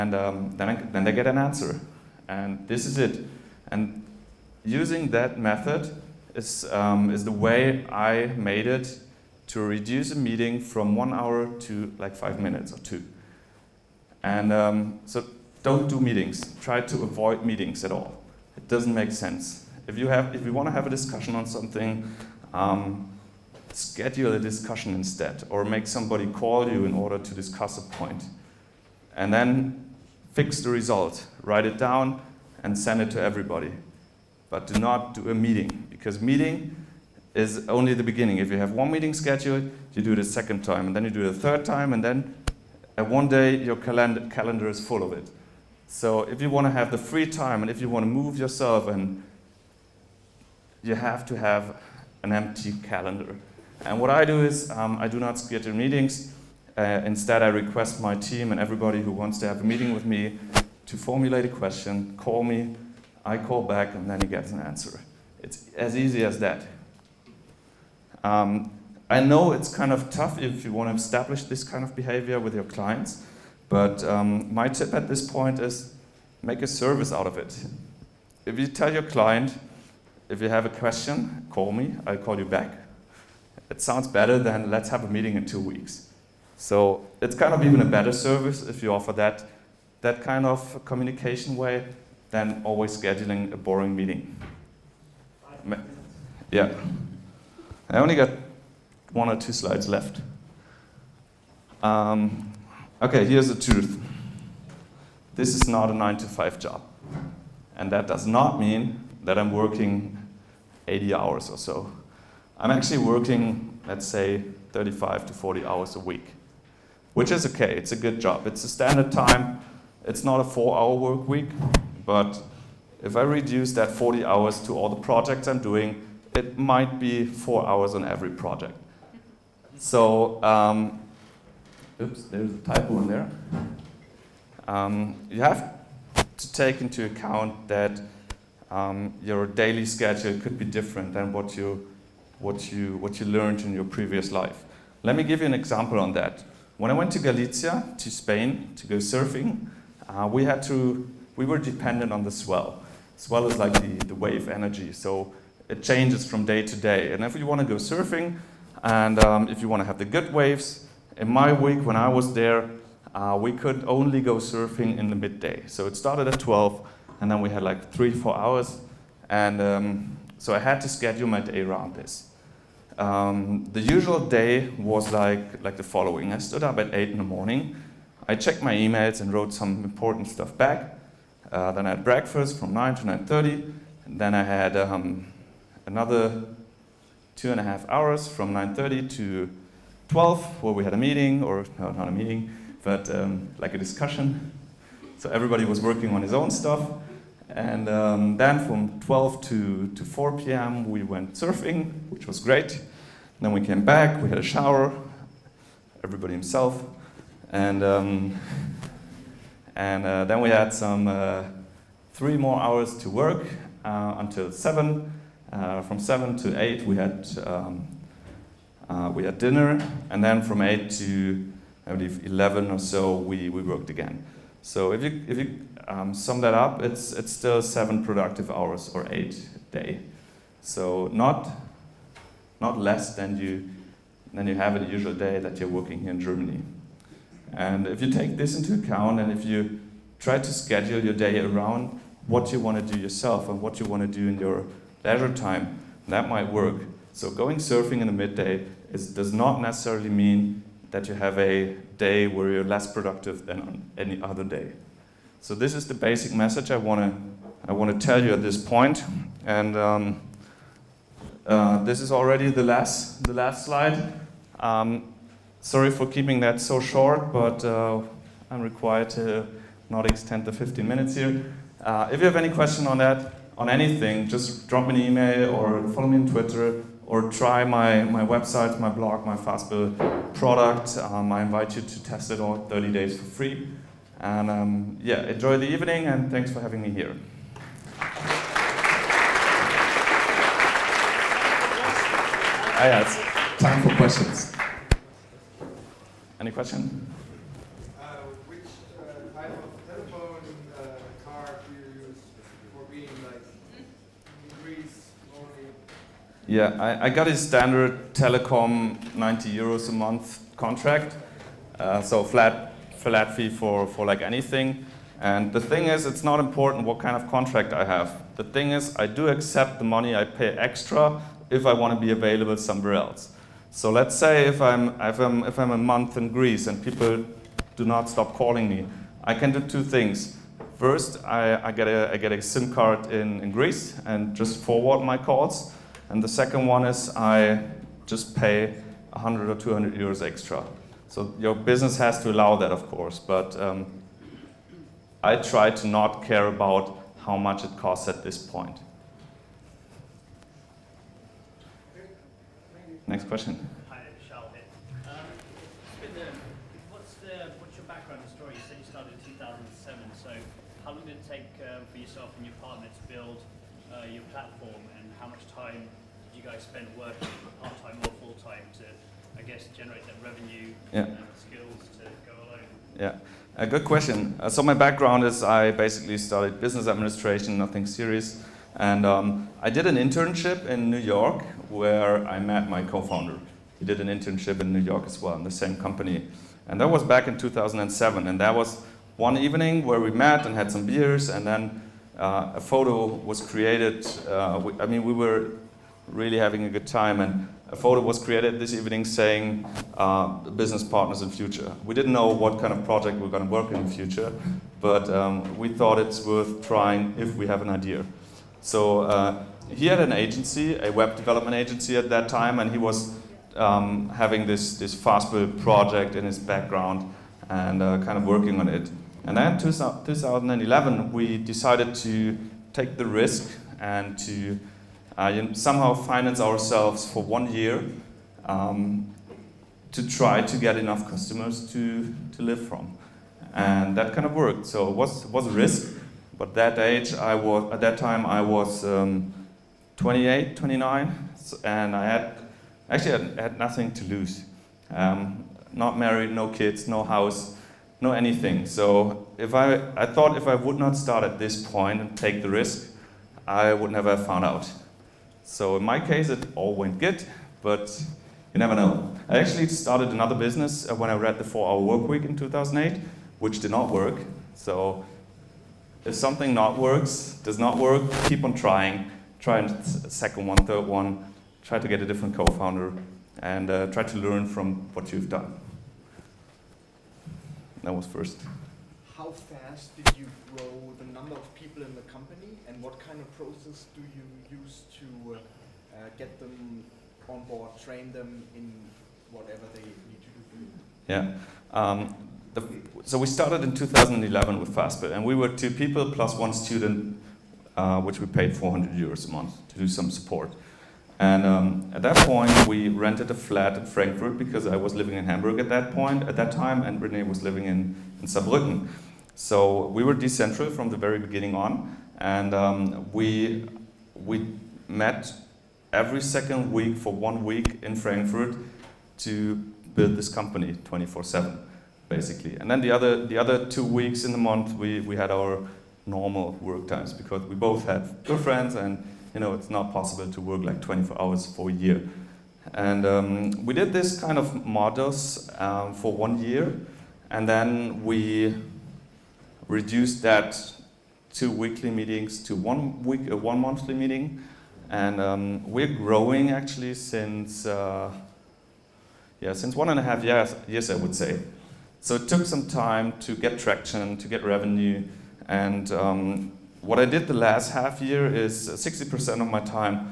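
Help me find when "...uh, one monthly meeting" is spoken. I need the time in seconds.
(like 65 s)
543 s.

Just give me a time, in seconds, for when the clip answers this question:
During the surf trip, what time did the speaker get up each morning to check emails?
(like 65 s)
176 s.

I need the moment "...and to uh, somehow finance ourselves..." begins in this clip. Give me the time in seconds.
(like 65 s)
423 s.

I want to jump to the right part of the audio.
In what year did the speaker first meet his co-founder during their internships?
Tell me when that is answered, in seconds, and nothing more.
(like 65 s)
387 s.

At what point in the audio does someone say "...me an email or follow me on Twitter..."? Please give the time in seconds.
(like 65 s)
274 s.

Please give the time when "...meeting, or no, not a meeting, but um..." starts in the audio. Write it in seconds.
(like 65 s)
190 s.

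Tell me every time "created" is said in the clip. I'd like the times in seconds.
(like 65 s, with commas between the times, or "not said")
393 s, 398 s.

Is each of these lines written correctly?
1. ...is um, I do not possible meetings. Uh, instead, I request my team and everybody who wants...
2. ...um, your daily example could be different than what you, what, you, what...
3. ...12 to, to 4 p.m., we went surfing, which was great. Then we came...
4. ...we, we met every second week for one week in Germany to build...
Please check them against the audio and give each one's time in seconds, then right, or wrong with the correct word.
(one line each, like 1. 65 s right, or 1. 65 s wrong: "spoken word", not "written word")
1. 54 s wrong: "schedule", not "possible"
2. 138 s wrong: "schedule", not "example"
3. 199 s right
4. 513 s wrong: "Frankfurt", not "Germany".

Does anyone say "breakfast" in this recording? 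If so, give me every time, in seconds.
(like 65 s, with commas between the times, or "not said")
182 s.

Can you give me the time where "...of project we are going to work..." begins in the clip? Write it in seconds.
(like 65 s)
402 s.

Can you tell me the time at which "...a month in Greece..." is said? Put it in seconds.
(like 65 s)
325 s.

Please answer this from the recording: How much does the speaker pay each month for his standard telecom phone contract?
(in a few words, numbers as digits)
90 euros.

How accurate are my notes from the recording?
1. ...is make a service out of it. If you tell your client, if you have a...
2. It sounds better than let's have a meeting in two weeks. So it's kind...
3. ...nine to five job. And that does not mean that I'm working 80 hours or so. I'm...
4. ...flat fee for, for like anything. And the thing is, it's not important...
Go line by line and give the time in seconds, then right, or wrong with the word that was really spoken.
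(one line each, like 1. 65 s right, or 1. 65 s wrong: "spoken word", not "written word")
1. 75 s right
2. 83 s right
3. 105 s right
4. 312 s right.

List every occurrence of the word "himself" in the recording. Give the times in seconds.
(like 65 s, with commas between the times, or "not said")
206 s.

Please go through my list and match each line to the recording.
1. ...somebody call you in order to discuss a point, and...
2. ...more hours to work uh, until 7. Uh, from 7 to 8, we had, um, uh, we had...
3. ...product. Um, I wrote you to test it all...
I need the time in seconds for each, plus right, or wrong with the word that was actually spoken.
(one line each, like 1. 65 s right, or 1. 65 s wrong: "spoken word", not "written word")
1. 25 s right
2. 212 s right
3. 280 s wrong: "invite", not "wrote".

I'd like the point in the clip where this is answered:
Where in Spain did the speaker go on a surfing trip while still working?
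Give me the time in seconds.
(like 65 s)
147 s.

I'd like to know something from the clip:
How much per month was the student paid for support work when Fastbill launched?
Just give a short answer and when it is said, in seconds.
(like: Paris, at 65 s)
400 euros, at 498 s.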